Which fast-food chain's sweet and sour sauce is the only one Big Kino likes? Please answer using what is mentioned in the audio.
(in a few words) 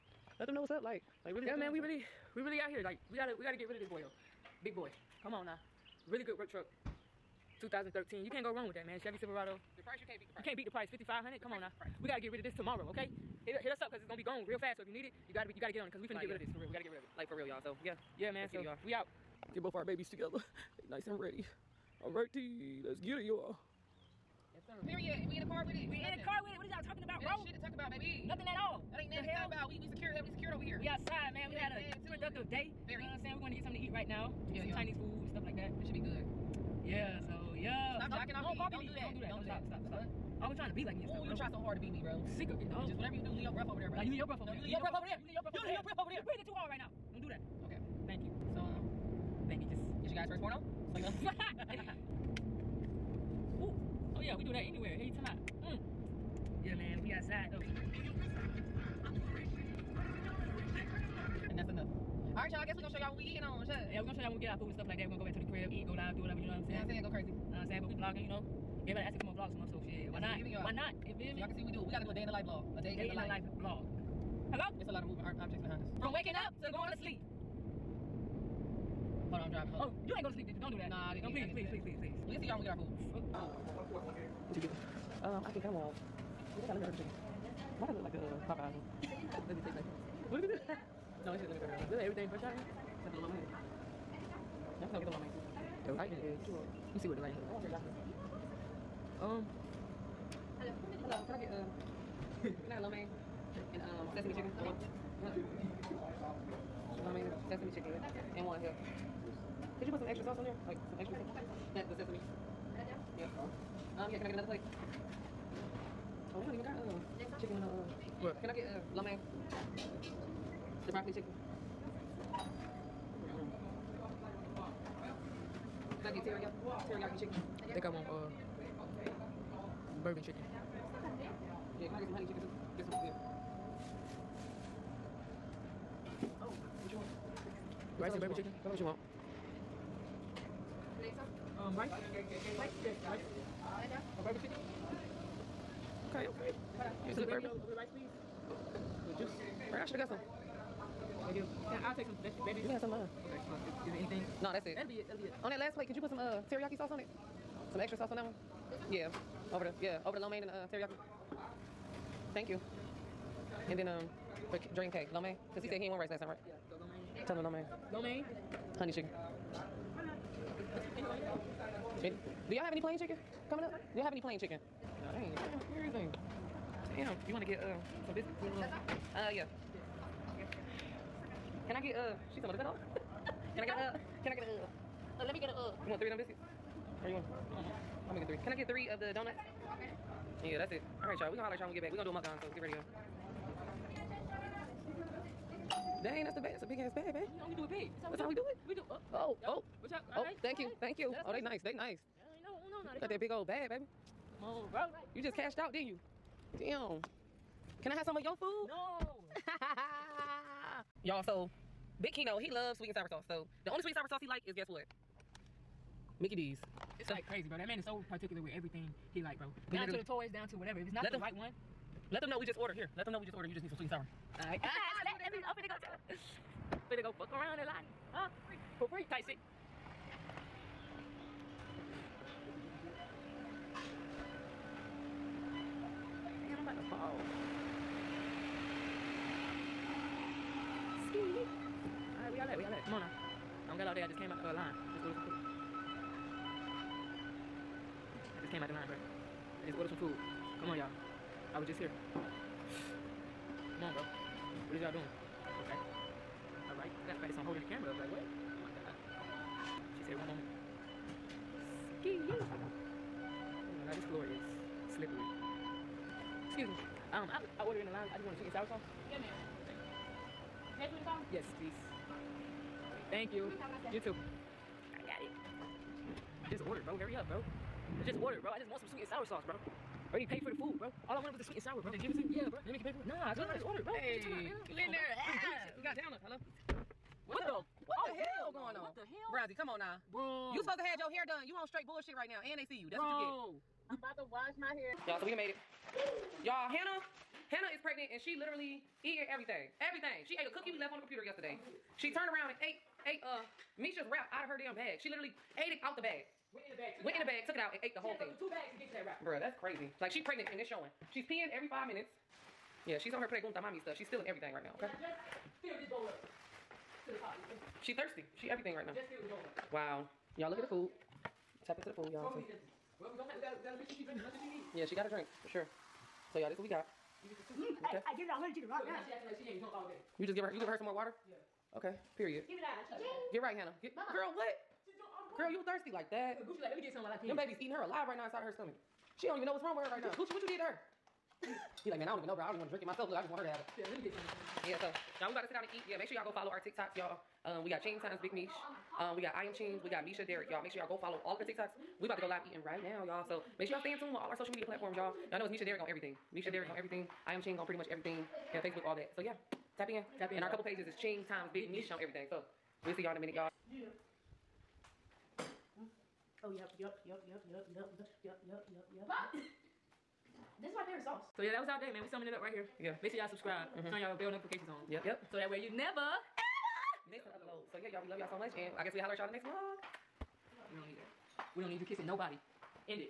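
Mickey D's.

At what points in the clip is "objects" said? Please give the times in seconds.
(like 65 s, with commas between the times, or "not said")
75 s.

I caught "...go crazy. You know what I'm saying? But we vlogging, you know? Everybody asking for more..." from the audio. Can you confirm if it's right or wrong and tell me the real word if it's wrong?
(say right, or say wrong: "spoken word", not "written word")
right.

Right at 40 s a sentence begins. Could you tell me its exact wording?
Always trying to be like me and stuff.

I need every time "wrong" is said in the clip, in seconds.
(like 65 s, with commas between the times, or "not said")
8 s, 339 s.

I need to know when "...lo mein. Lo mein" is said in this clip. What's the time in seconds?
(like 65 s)
167 s.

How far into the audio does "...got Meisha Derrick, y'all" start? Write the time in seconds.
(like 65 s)
349 s.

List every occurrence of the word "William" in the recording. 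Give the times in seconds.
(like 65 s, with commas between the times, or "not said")
not said.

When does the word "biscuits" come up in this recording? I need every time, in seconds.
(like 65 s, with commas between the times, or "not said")
178 s, 186 s.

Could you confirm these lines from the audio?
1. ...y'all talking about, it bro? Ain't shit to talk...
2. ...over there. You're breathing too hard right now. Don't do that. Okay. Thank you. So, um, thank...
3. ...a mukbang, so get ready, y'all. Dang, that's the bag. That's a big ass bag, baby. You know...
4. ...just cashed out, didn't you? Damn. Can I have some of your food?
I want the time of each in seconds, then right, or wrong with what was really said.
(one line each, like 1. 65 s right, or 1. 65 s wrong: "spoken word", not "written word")
1. 26 s right
2. 45 s right
3. 192 s right
4. 205 s right.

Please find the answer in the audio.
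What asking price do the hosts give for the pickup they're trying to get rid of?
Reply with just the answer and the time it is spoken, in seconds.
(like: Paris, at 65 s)
5500, at 10 s.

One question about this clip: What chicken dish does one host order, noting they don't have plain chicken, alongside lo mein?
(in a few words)
bourbon chicken.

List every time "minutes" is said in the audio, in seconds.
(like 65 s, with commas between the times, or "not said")
311 s, 363 s.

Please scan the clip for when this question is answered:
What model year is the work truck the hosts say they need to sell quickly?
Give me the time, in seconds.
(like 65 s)
7 s.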